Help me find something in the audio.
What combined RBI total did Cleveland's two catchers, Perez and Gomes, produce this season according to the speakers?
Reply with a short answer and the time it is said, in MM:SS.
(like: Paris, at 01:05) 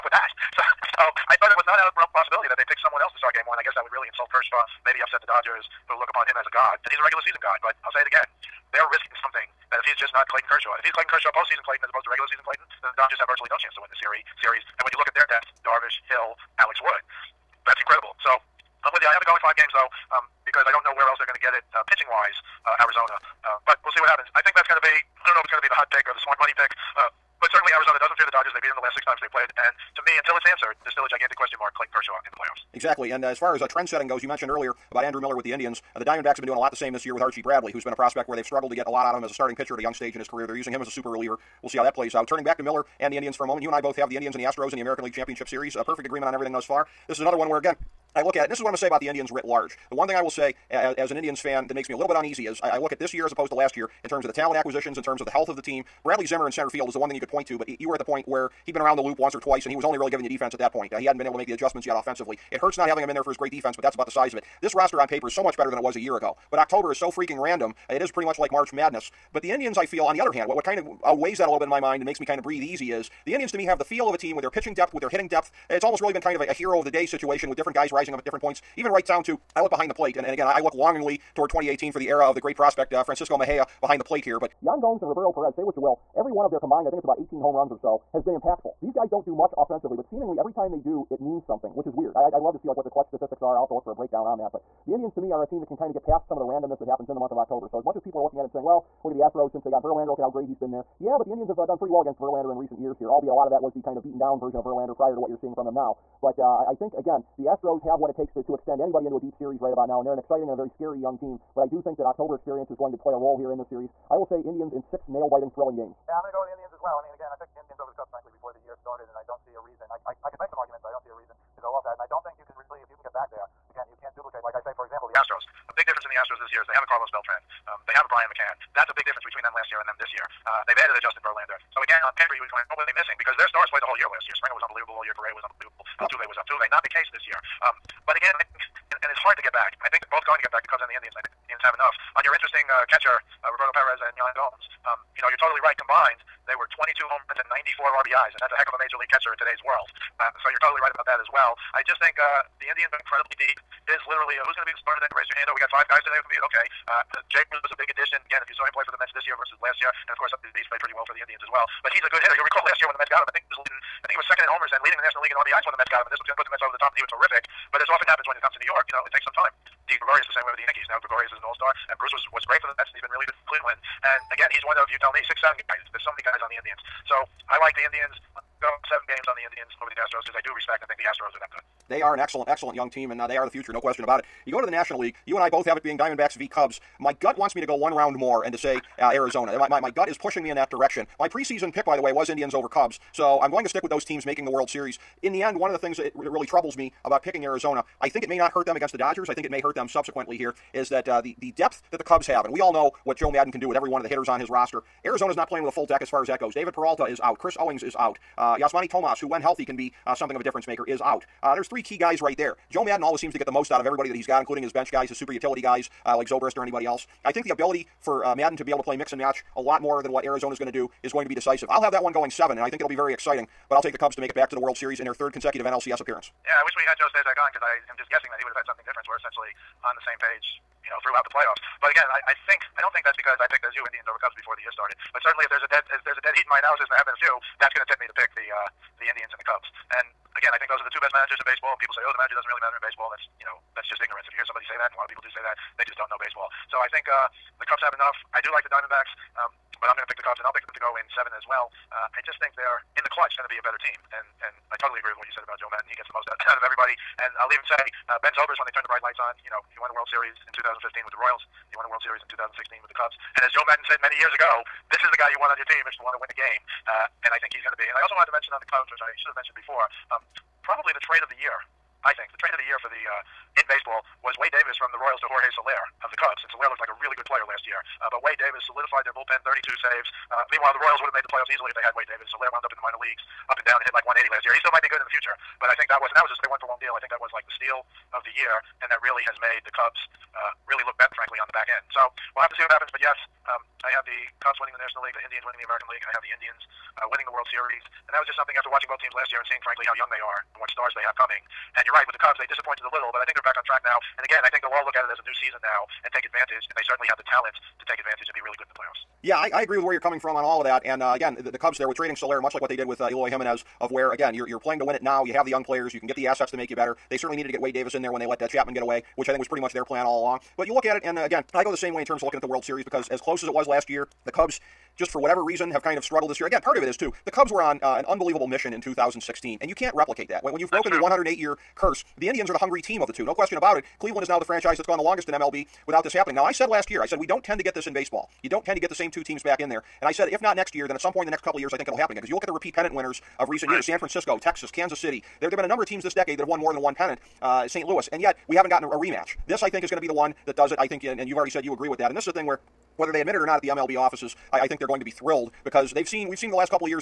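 94, at 02:27.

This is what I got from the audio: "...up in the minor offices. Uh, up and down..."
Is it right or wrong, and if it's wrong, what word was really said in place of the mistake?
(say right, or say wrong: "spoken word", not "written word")
wrong: "leagues", not "offices".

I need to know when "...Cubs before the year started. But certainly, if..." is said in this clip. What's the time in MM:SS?
03:54.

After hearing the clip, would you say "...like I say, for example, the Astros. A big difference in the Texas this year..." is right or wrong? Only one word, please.
wrong.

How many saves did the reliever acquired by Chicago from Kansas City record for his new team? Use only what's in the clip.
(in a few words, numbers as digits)
32.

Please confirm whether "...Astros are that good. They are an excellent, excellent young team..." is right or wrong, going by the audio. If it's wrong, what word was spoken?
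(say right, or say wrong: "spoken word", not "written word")
right.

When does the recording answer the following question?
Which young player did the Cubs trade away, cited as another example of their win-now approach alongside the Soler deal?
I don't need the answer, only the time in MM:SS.
05:13.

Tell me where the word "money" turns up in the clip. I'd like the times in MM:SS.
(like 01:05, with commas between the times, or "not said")
00:26.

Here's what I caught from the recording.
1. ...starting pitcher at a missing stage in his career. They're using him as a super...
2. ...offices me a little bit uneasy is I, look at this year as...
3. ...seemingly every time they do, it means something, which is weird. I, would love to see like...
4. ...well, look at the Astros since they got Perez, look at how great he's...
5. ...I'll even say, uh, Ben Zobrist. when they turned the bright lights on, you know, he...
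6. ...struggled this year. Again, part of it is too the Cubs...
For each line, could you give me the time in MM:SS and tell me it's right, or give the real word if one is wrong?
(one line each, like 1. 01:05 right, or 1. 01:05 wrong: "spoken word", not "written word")
1. 00:39 wrong: "young", not "missing"
2. 00:51 wrong: "makes", not "offices"
3. 01:30 right
4. 01:38 wrong: "Verlander", not "Perez"
5. 04:17 right
6. 05:26 right.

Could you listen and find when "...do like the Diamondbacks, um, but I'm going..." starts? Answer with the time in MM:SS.
04:08.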